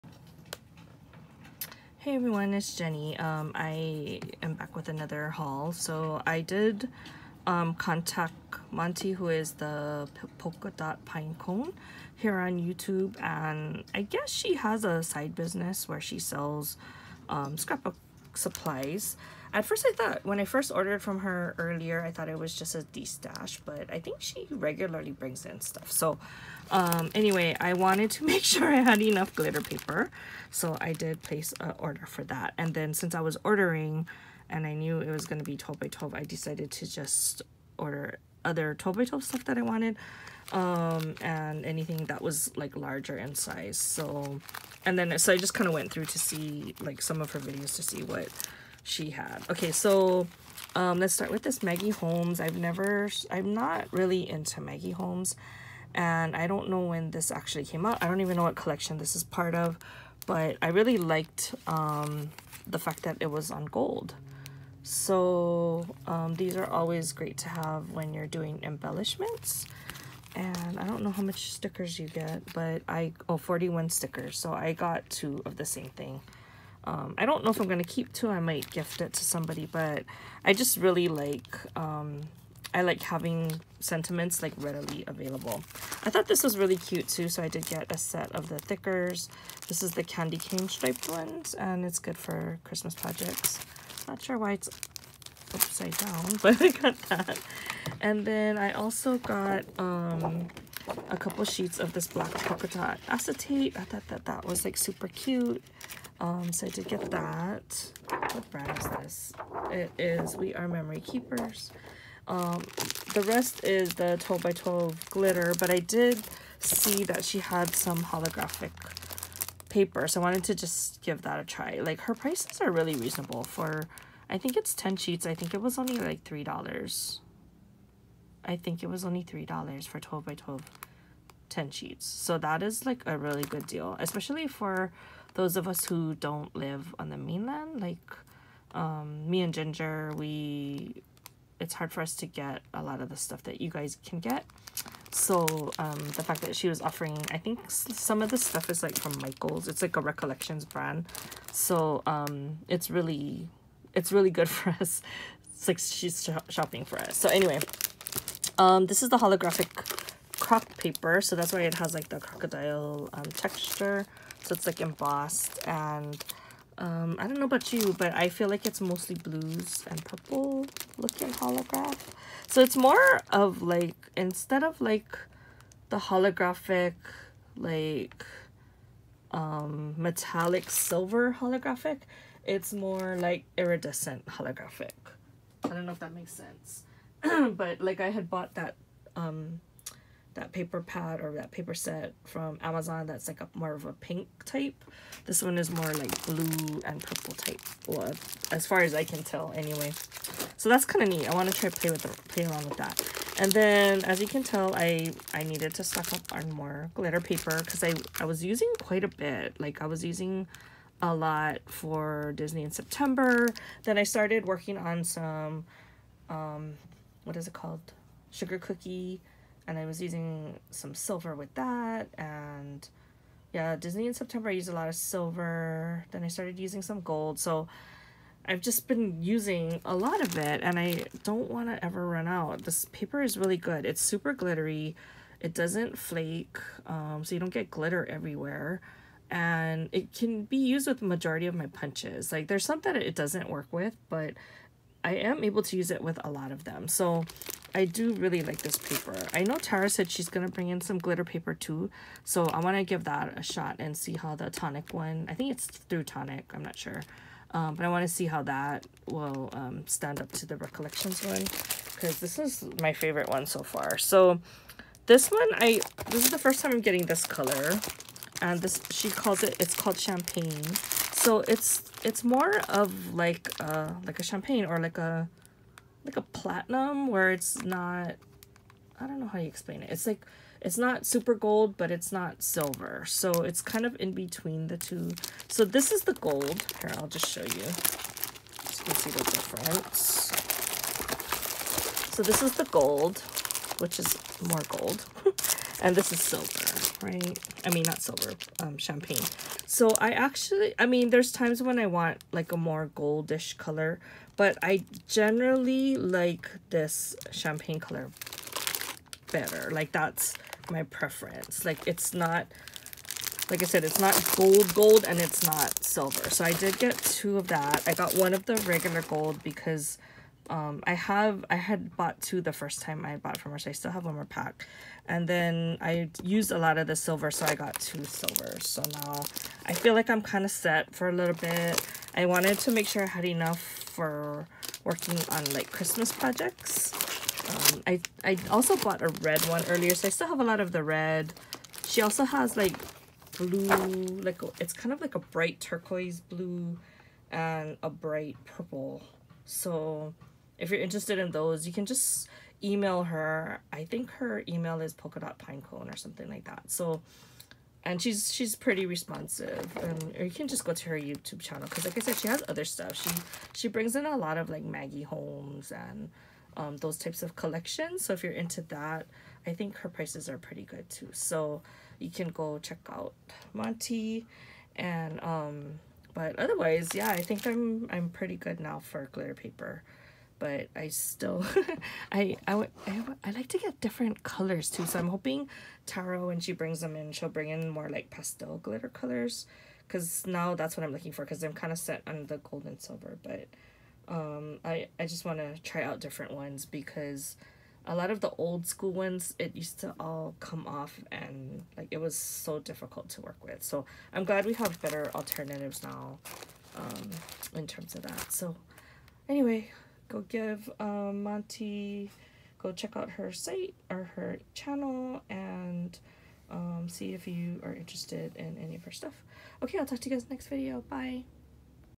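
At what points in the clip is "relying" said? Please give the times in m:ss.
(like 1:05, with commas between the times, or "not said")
not said.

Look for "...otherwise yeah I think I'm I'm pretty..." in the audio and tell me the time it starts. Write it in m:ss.
6:16.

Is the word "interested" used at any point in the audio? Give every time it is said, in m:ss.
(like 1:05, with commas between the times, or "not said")
5:50, 6:57.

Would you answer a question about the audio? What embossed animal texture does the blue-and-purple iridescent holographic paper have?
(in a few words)
crocodile.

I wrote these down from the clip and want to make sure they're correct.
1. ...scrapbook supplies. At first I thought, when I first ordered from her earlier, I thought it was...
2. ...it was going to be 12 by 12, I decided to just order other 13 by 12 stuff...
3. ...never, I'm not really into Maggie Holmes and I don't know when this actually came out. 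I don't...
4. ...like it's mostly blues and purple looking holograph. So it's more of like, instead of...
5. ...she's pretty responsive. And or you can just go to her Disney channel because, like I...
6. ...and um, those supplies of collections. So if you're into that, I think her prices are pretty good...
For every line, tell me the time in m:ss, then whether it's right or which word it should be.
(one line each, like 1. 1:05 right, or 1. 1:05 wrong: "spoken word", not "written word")
1. 0:17 right
2. 0:34 wrong: "12", not "13"
3. 0:52 right
4. 2:48 right
5. 5:58 wrong: "YouTube", not "Disney"
6. 6:05 wrong: "types", not "supplies".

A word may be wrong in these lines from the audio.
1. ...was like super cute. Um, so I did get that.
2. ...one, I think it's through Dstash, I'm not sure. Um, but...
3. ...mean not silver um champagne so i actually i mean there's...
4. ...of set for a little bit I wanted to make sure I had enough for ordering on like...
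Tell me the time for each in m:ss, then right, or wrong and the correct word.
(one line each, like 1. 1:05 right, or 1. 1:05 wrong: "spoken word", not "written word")
1. 1:44 right
2. 4:14 wrong: "Tonic", not "Dstash"
3. 4:57 right
4. 5:30 wrong: "working", not "ordering".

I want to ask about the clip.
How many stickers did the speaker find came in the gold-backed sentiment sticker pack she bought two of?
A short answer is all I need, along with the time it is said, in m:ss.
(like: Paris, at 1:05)
41, at 1:13.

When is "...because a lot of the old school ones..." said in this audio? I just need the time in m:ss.
6:36.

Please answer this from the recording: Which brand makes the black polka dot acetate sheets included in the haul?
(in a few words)
We Are Memory Keepers.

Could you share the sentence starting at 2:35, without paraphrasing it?
It's like she's shopping for us.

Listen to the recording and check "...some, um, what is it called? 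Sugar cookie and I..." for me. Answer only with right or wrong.
right.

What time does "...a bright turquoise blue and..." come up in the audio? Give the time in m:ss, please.
5:45.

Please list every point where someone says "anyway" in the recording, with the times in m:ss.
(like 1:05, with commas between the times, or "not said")
0:27, 2:37, 3:19, 6:49.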